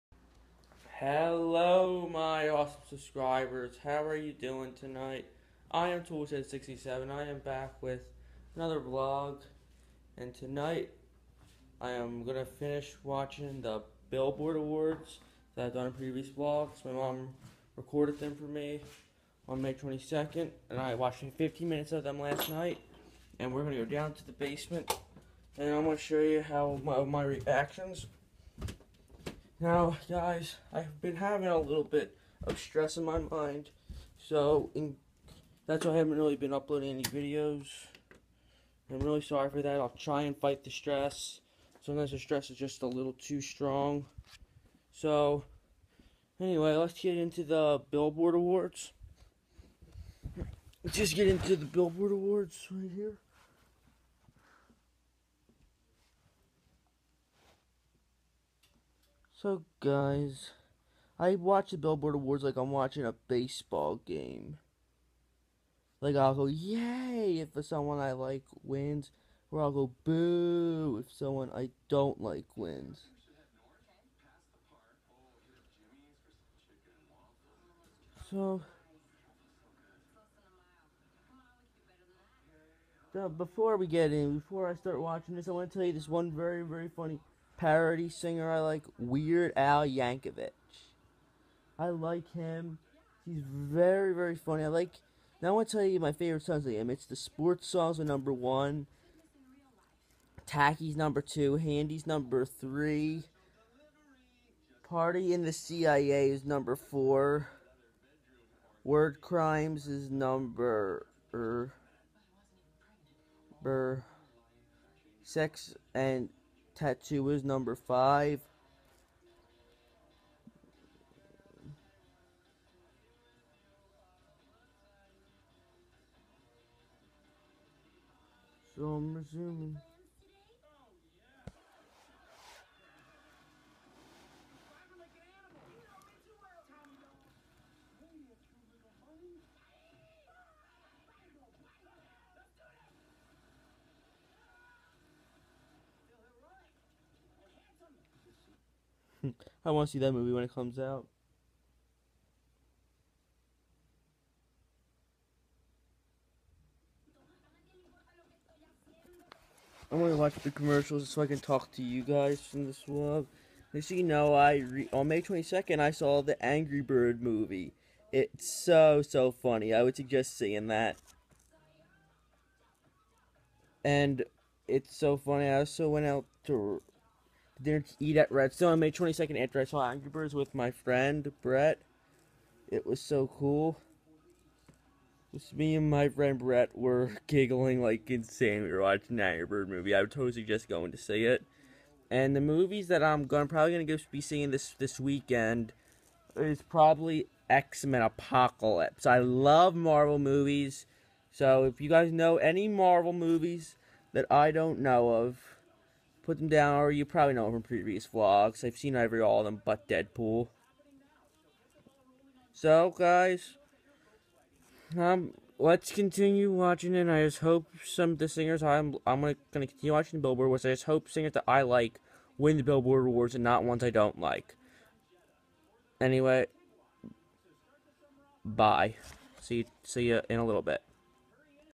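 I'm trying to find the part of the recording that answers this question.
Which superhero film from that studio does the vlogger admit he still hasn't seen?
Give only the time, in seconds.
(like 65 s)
209 s.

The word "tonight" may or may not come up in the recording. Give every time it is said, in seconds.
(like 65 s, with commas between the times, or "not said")
4 s, 10 s.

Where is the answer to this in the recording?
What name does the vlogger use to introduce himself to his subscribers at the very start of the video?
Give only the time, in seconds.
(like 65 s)
6 s.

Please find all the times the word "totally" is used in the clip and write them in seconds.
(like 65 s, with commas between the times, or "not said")
190 s.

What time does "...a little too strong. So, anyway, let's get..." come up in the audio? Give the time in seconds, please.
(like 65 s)
42 s.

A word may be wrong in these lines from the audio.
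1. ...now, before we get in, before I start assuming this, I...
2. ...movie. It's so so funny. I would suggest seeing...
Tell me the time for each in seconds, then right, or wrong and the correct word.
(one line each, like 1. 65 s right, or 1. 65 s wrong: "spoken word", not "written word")
1. 83 s wrong: "watching", not "assuming"
2. 167 s right.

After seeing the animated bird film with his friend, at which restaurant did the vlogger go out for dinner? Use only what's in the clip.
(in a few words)
Redstone.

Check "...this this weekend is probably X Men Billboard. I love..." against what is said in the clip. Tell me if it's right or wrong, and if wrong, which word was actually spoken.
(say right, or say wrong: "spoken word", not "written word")
wrong: "Apocalypse", not "Billboard".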